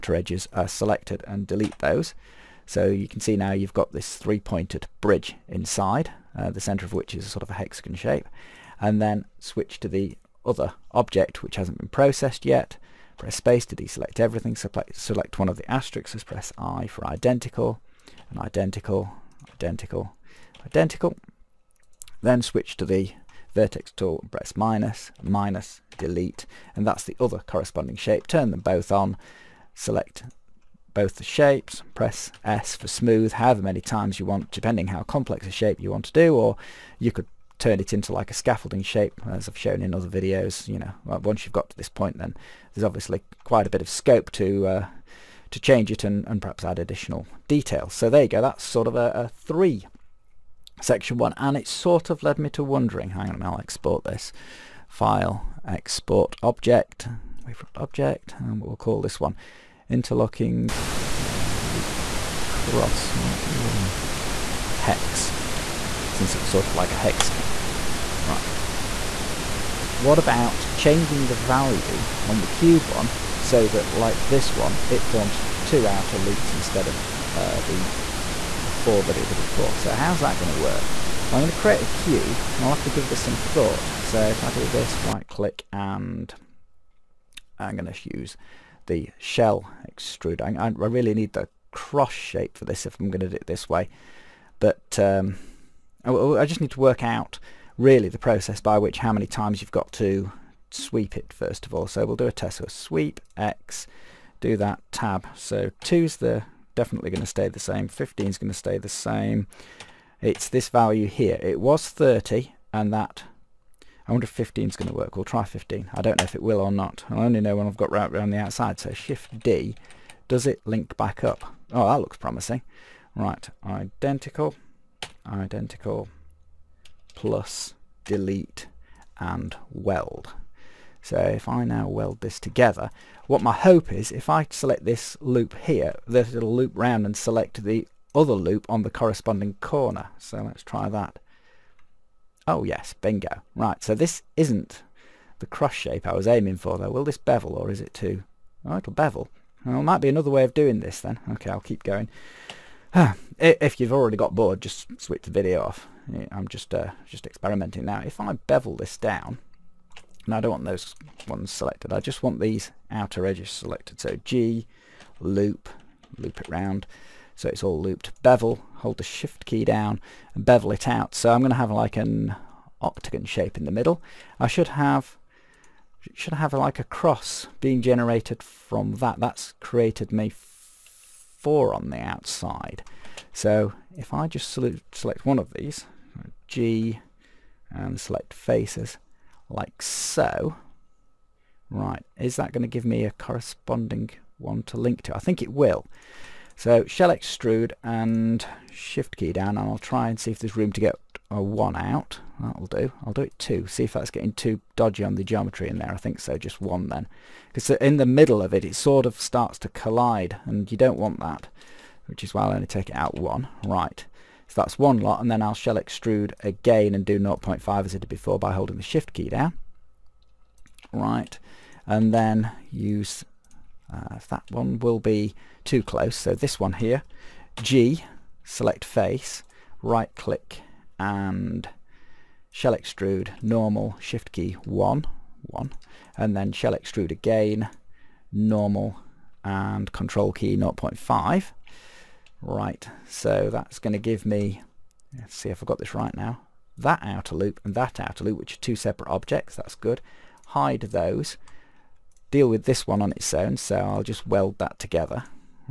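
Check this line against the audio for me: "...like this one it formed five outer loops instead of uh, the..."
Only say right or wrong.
wrong.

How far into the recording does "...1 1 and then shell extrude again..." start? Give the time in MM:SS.
03:54.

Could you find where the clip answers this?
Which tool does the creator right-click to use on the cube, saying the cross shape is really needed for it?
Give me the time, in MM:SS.
01:29.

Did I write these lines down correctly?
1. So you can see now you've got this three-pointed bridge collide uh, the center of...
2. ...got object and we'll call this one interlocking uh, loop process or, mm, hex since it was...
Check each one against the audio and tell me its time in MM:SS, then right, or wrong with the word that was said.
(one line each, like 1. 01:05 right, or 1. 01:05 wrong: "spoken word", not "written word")
1. 00:02 wrong: "inside", not "collide"
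2. 00:57 wrong: "cross", not "process".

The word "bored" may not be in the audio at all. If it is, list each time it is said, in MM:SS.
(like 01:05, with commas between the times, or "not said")
02:34.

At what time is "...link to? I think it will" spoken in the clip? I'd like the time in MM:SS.
03:14.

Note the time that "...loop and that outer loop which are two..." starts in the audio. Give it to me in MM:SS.
04:07.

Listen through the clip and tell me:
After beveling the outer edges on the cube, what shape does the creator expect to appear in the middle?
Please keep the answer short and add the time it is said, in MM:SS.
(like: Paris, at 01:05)
octagon, at 02:52.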